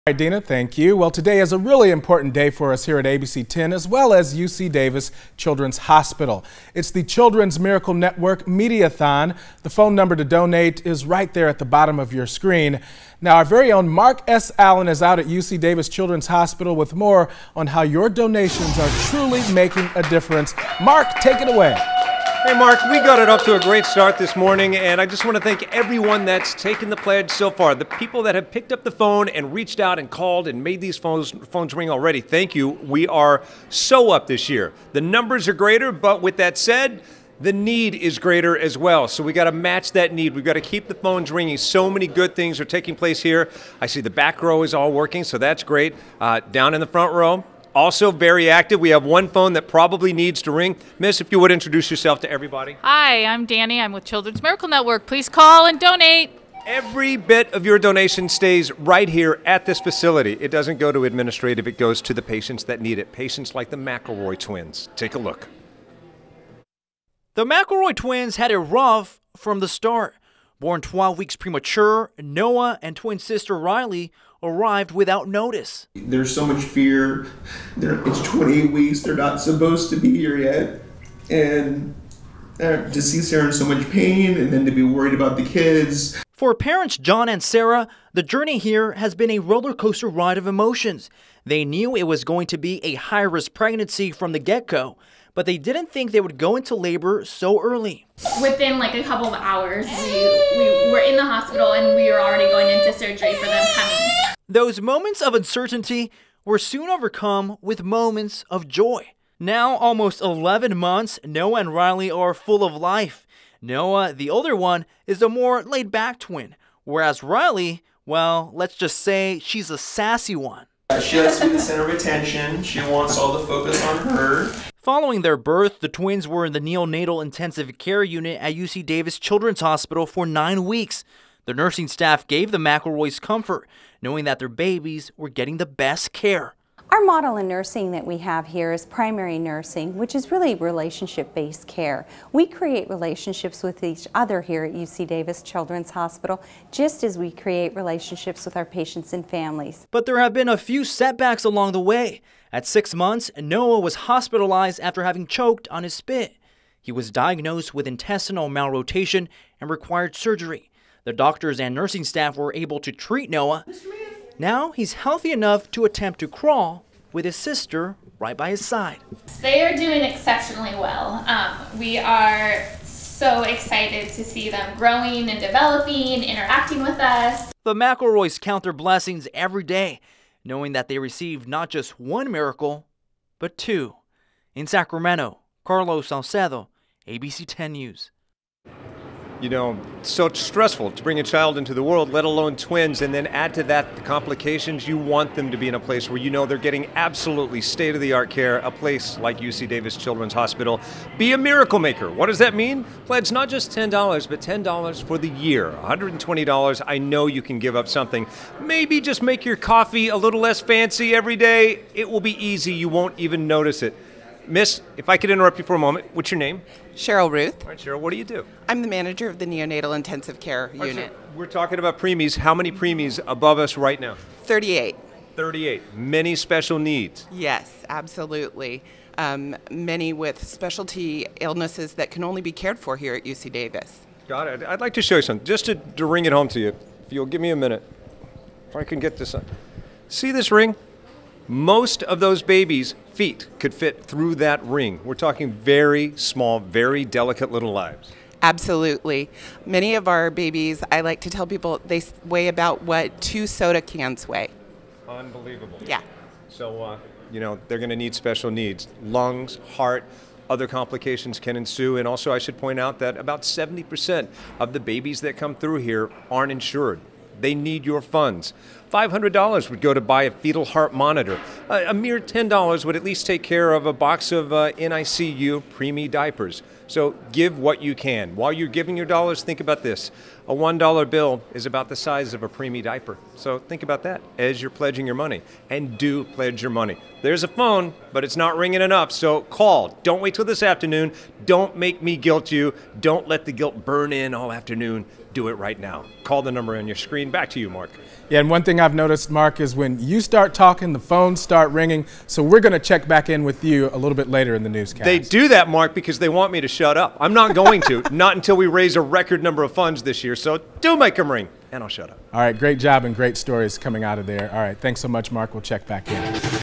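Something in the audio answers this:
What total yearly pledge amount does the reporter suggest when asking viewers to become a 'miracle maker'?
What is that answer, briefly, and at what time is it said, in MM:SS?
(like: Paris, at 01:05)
$120, at 03:25.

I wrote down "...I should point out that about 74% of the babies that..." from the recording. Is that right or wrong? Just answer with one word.
wrong.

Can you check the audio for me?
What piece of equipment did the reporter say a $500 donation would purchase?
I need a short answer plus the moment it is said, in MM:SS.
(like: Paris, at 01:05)
fetal heart monitor, at 04:30.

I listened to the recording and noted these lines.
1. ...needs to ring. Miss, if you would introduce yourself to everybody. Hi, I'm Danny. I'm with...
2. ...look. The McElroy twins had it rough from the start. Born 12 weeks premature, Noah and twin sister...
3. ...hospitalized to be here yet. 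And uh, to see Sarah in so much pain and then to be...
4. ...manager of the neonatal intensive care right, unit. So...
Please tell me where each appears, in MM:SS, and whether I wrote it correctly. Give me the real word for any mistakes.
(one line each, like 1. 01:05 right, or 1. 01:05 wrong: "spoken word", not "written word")
1. 00:50 right
2. 01:05 right
3. 01:19 wrong: "supposed", not "hospitalized"
4. 03:38 right.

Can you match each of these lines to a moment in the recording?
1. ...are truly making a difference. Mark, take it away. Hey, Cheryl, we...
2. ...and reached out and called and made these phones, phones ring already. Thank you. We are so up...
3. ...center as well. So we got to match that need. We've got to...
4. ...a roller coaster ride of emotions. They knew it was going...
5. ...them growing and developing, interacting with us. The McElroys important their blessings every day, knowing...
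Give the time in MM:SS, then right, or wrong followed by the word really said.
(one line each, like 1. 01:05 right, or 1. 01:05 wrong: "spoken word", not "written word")
1. 00:18 wrong: "Mark", not "Cheryl"
2. 00:29 right
3. 00:38 wrong: "greater", not "center"
4. 01:29 right
5. 02:54 wrong: "count", not "important".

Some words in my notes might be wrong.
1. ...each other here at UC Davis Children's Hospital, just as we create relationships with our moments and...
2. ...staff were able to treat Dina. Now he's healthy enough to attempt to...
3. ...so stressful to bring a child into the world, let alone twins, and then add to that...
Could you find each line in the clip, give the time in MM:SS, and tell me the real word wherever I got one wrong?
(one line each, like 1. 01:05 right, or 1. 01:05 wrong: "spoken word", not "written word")
1. 02:23 wrong: "patients", not "moments"
2. 02:42 wrong: "Noah", not "Dina"
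3. 03:10 right.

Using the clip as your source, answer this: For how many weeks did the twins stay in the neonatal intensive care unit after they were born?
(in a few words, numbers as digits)
9.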